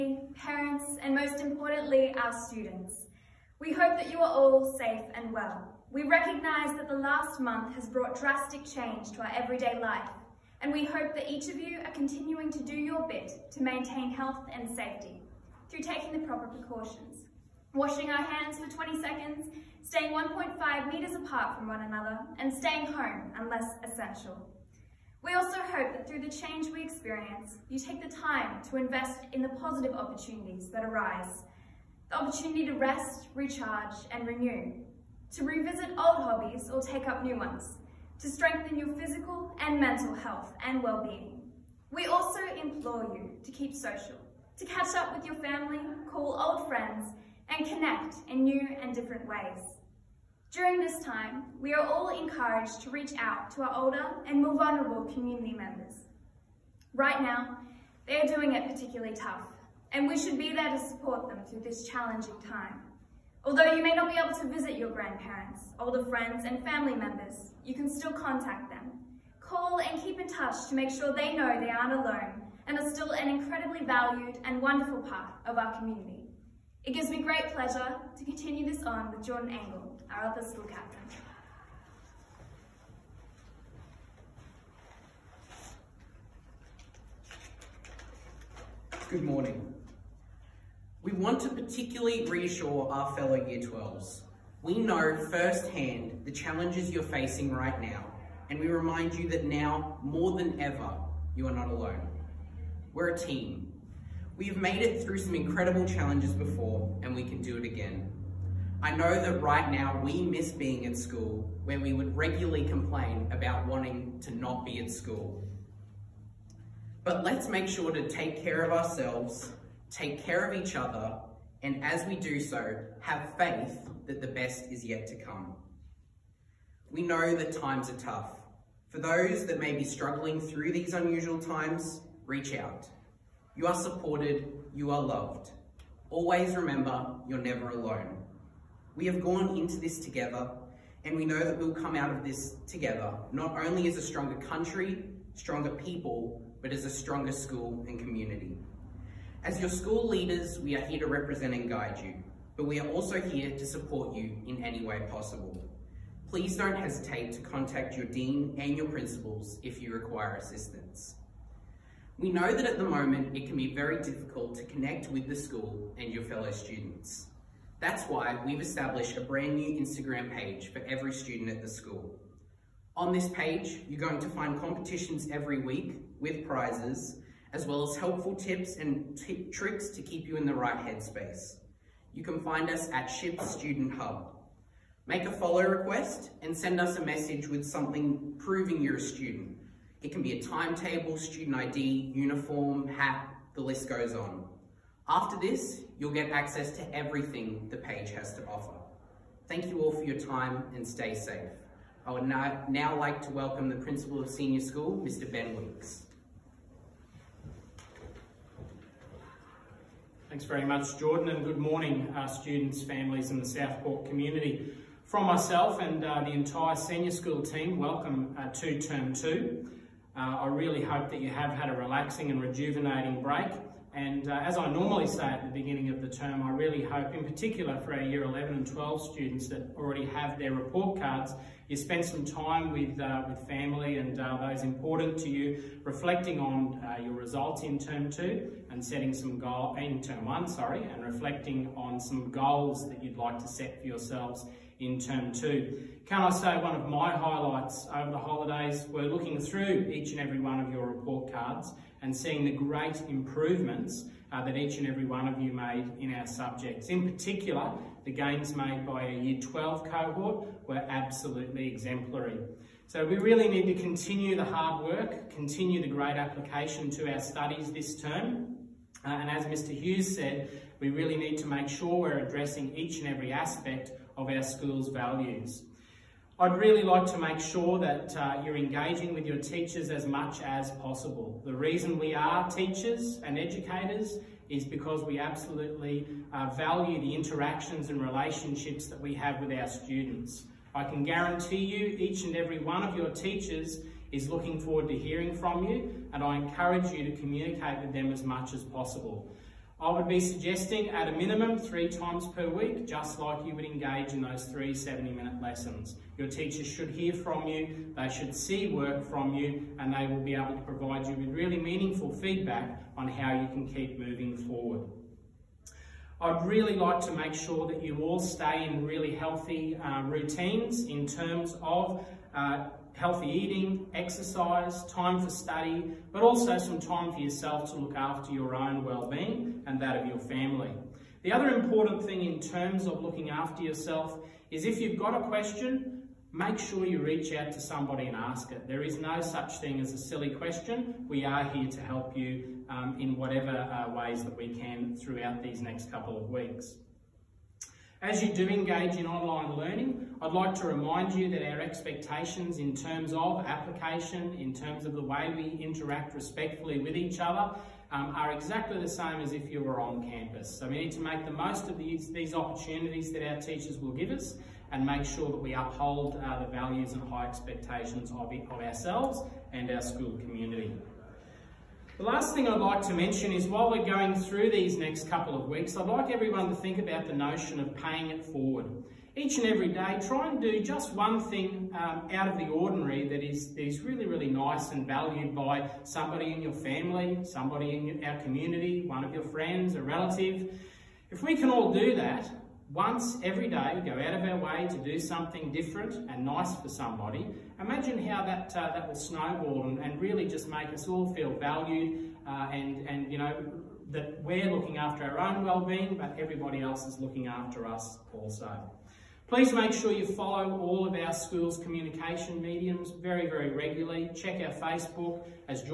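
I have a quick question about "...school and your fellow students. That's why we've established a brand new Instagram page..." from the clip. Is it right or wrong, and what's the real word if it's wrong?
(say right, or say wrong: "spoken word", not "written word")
right.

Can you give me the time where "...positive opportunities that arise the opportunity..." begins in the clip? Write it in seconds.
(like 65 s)
29 s.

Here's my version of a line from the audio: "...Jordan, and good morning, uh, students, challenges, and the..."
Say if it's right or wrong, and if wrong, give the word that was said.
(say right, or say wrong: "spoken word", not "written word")
wrong: "families", not "challenges".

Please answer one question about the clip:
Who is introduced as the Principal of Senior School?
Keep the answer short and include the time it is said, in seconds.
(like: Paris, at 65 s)
Ben Weeks, at 205 s.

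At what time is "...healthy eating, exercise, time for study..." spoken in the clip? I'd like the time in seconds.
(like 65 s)
322 s.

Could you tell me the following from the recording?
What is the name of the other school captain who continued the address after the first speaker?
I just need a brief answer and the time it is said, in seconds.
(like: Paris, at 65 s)
Jordan Engel, at 79 s.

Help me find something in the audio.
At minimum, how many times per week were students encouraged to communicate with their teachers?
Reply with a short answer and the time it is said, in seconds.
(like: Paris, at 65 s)
3, at 301 s.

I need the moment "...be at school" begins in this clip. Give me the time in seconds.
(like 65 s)
114 s.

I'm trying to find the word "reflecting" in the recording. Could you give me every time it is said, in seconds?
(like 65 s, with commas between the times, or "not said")
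235 s, 241 s.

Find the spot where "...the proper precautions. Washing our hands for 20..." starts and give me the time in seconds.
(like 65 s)
16 s.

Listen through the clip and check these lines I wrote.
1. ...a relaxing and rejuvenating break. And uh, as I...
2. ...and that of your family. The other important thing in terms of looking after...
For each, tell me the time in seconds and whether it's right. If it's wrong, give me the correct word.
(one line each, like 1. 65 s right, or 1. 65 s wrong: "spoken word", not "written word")
1. 221 s right
2. 329 s right.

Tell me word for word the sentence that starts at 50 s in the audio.
During this time, we are all encouraged to reach out to our older and more vulnerable community members.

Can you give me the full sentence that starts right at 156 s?
Please don't hesitate to contact your dean and your principals if you require assistance.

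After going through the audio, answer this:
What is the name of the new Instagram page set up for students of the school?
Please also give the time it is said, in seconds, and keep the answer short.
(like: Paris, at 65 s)
SHIP Student Hub, at 183 s.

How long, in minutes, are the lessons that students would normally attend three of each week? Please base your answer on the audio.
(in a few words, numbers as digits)
70.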